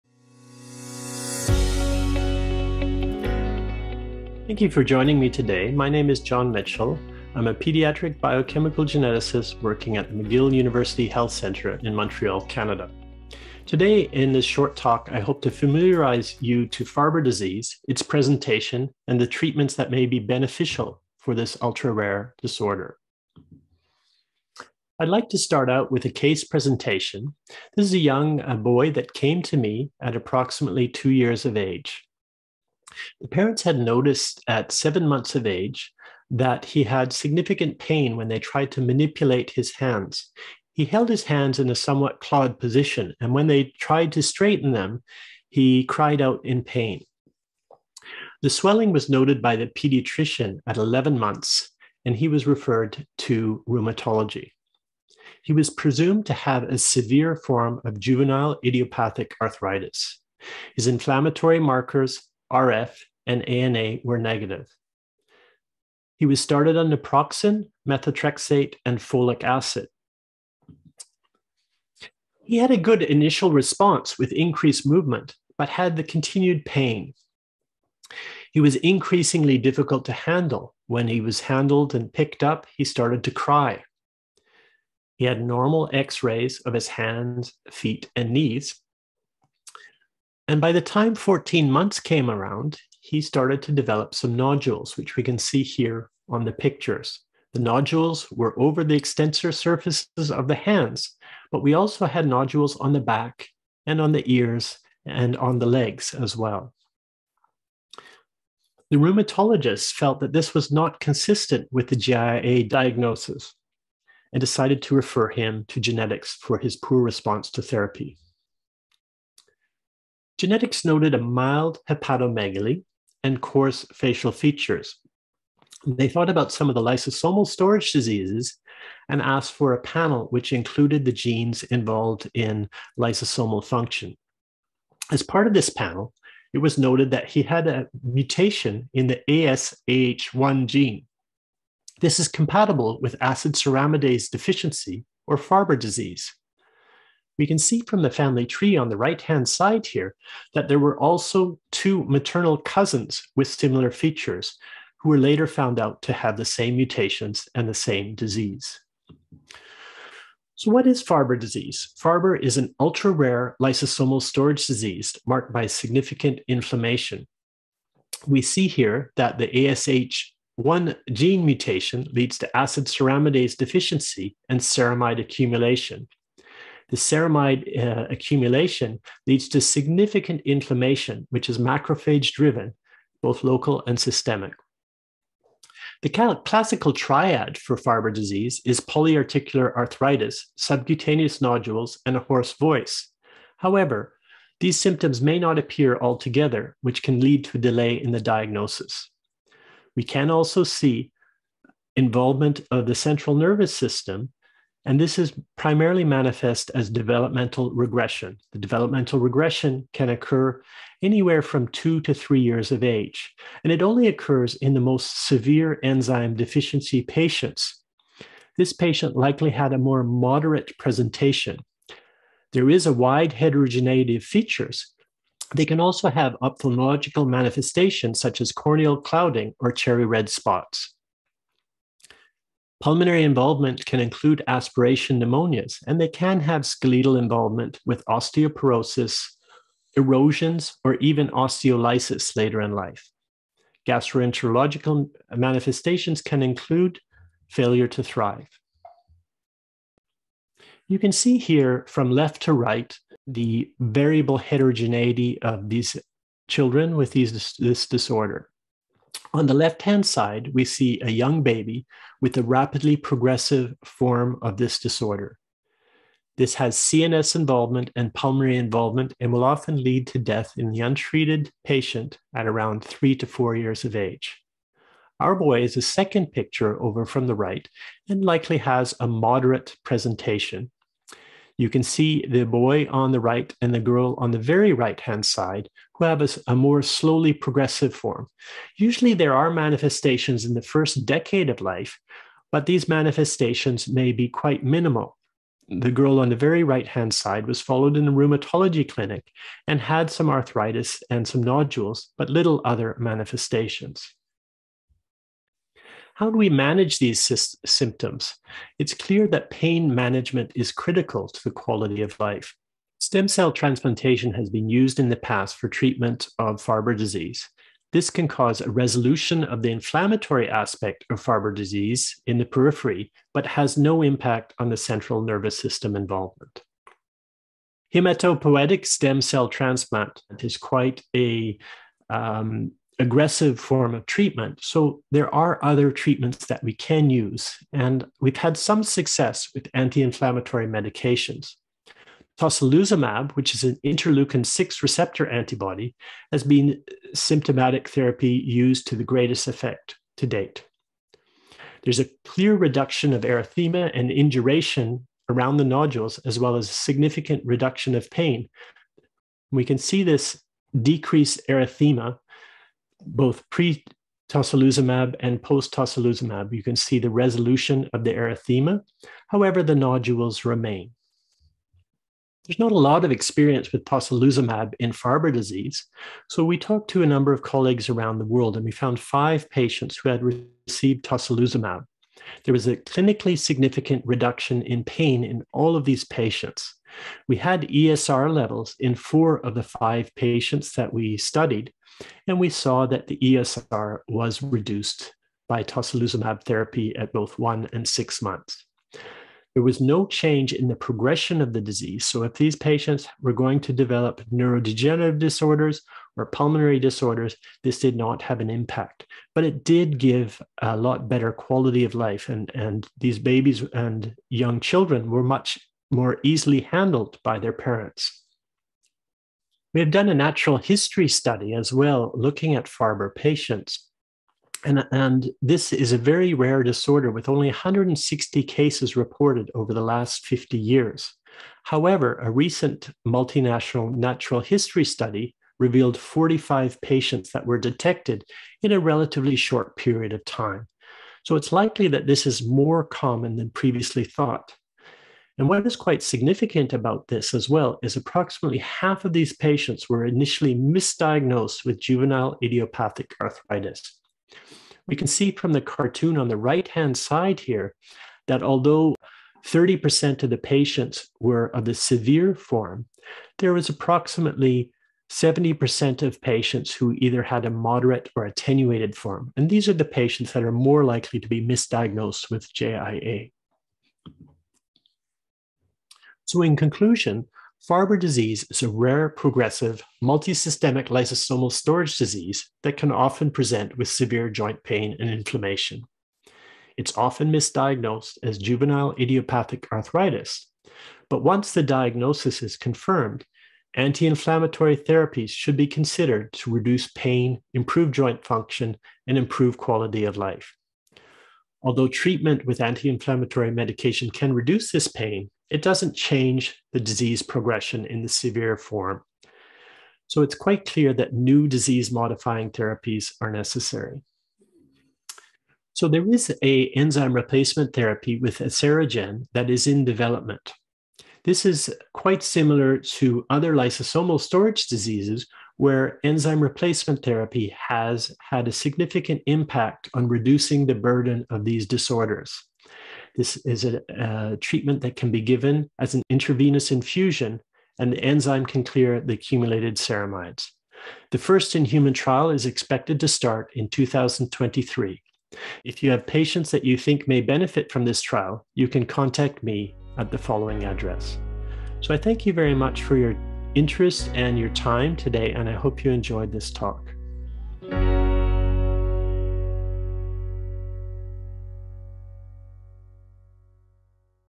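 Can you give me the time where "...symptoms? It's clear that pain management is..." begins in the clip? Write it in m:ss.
5:07.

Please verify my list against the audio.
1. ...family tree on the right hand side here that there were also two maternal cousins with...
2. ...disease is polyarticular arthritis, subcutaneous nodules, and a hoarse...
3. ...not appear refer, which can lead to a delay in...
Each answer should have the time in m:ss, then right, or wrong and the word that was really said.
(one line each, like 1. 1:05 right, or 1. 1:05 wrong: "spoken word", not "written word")
1. 2:28 right
2. 3:08 right
3. 3:15 wrong: "altogether", not "refer".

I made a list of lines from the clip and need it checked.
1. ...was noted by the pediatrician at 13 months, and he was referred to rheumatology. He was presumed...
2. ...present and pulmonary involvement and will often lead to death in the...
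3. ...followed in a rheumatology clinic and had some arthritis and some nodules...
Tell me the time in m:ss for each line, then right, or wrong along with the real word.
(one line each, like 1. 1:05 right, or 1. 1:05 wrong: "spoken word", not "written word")
1. 0:48 wrong: "11", not "13"
2. 4:27 wrong: "involvement", not "present"
3. 4:57 right.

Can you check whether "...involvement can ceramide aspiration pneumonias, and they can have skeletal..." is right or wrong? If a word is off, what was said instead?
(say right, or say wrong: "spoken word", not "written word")
wrong: "include", not "ceramide".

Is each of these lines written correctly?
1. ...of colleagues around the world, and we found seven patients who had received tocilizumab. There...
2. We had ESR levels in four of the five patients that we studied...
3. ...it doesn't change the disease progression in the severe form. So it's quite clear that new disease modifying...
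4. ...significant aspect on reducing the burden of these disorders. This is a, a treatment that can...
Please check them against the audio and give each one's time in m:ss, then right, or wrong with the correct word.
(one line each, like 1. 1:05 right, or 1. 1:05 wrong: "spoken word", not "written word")
1. 6:17 wrong: "five", not "seven"
2. 6:27 right
3. 8:25 right
4. 8:48 wrong: "impact", not "aspect".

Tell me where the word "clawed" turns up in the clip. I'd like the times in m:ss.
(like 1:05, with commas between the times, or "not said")
0:42.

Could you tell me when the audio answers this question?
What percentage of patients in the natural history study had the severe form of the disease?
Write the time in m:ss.
7:39.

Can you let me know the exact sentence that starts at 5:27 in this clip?
Hematopoietic stem cell transplant is quite a um, aggressive form of treatment.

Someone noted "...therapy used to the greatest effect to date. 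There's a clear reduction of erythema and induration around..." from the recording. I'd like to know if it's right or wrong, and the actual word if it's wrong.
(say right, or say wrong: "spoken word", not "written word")
right.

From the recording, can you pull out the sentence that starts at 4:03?
Gastroenterological manifestations can include failure to thrive.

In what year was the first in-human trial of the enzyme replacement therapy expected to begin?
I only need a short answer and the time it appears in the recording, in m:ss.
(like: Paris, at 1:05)
2023, at 9:03.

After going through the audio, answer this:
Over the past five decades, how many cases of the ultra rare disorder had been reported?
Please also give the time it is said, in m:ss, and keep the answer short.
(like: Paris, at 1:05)
160, at 7:07.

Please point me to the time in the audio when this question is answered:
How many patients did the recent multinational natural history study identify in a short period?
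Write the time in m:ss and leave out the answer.
7:15.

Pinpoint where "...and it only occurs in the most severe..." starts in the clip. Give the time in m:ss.
3:33.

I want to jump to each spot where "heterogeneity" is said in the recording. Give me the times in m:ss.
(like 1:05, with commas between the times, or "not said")
3:43, 4:14.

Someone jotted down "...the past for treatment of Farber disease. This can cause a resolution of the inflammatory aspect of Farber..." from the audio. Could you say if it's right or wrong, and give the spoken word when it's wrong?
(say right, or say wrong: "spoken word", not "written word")
right.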